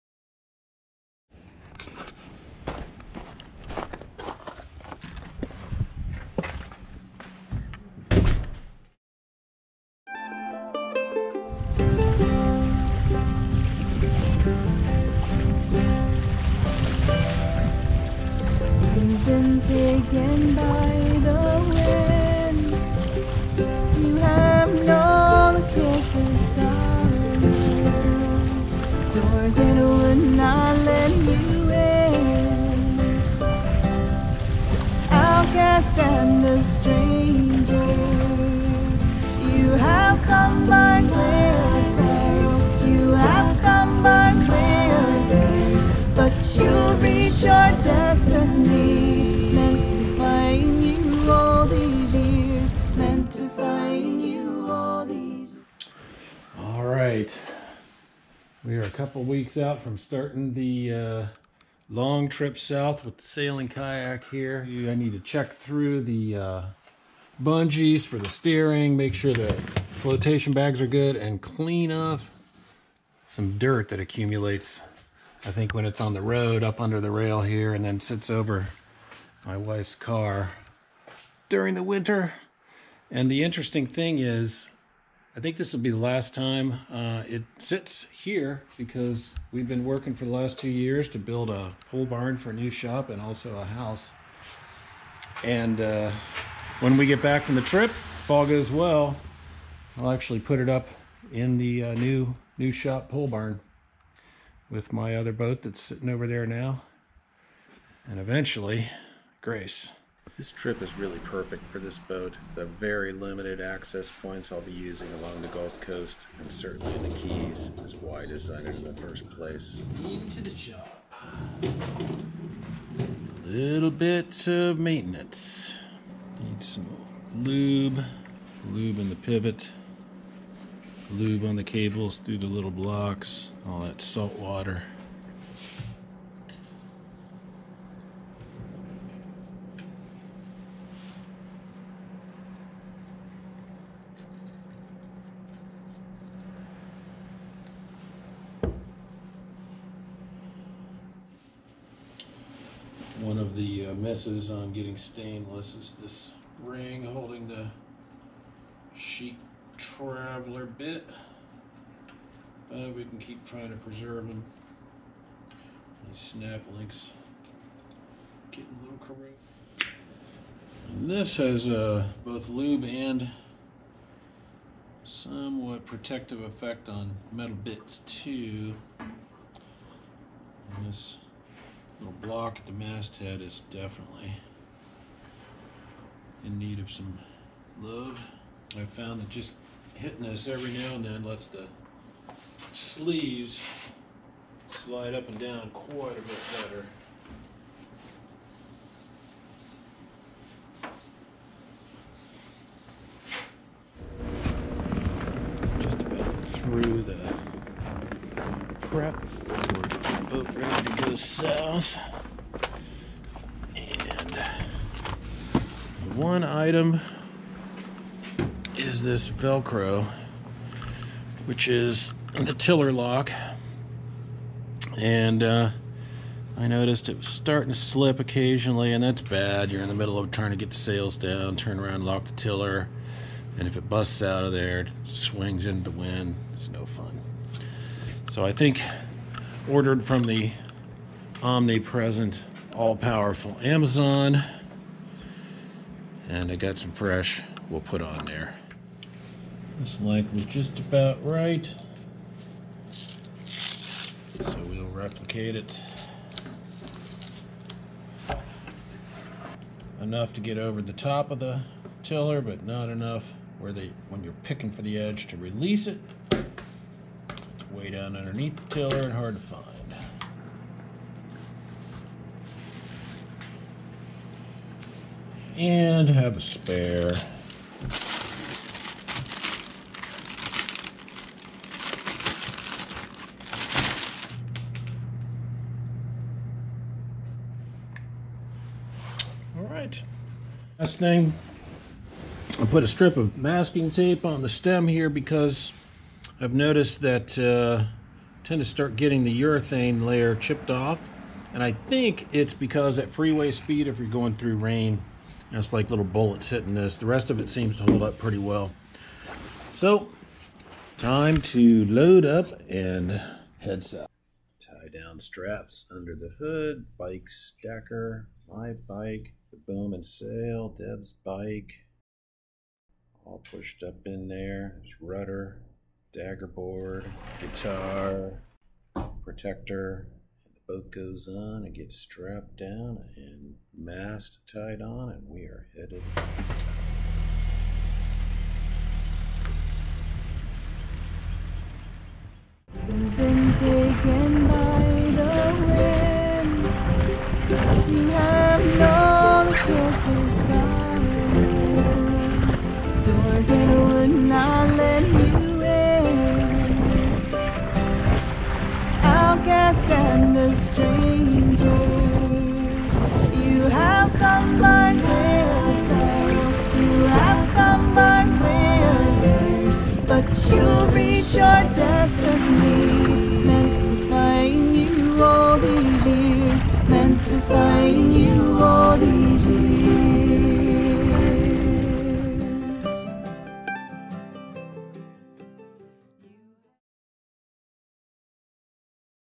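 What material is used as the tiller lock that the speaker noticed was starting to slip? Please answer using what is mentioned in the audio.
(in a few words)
Velcro.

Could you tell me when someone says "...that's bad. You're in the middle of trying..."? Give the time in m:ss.
3:49.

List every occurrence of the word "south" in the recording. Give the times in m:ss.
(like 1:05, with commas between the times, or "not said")
1:02, 3:31, 5:13, 5:36.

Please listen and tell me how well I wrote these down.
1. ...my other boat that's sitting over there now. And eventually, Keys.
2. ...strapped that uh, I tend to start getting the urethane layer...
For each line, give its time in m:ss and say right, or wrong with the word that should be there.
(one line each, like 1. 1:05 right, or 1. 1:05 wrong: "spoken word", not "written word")
1. 1:44 wrong: "Grace", not "Keys"
2. 4:56 wrong: "noticed", not "strapped".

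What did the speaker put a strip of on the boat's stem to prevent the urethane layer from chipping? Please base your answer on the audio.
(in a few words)
masking tape.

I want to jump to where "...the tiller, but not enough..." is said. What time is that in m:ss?
4:21.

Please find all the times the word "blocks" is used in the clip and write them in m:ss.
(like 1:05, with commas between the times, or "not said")
2:12, 3:02.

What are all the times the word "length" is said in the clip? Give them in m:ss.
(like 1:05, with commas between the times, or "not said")
4:10.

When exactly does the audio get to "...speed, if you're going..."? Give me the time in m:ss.
5:03.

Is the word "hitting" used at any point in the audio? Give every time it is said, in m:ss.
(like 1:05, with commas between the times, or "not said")
3:09, 5:06.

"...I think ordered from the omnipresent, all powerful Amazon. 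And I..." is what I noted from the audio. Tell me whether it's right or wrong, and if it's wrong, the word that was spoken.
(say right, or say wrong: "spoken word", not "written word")
right.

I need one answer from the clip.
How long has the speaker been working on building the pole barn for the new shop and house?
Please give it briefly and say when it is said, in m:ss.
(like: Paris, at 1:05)
2 years, at 1:30.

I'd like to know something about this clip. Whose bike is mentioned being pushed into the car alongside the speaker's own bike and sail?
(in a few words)
Deb's.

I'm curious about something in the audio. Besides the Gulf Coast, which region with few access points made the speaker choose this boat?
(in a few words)
the Keys.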